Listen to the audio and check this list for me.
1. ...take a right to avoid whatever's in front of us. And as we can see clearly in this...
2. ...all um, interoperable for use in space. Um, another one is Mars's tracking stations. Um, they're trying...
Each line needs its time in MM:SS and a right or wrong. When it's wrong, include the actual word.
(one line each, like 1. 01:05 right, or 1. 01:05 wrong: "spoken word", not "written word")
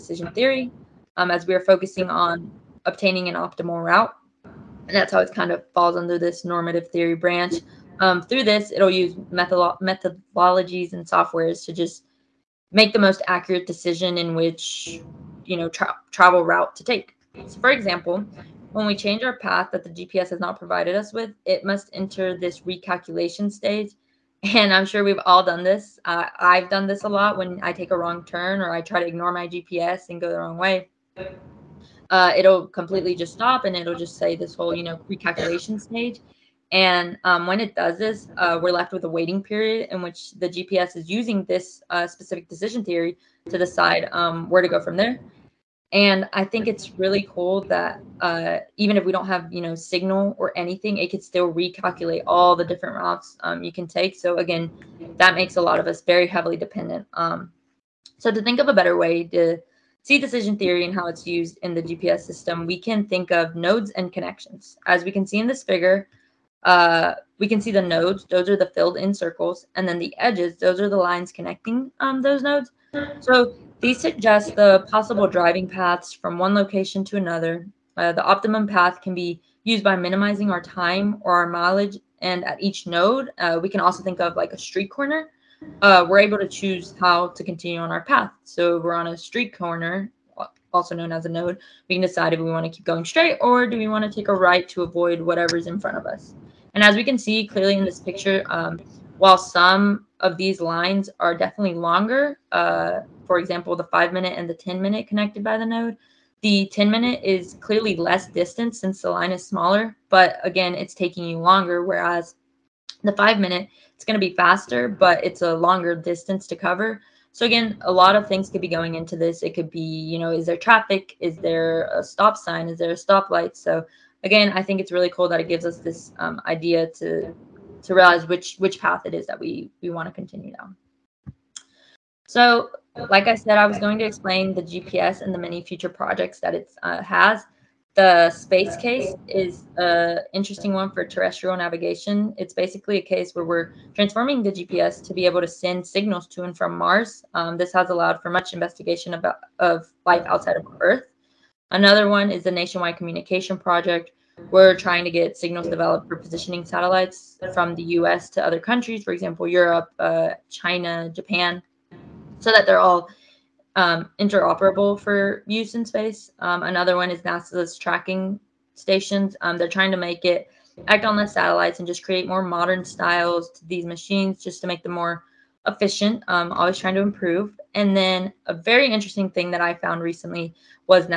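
1. 01:34 right
2. 02:42 wrong: "NASA", not "Mars".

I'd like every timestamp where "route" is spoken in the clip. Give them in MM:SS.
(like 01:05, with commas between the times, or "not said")
00:03, 00:16, 00:52.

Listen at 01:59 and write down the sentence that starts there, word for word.
It could be, you know, is there traffic?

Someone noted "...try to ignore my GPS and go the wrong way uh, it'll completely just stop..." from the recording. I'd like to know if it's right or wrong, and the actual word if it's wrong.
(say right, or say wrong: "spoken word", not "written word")
right.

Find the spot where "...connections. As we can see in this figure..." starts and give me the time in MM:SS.
01:04.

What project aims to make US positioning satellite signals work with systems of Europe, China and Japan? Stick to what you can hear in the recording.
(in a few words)
Nationwide Communication Project.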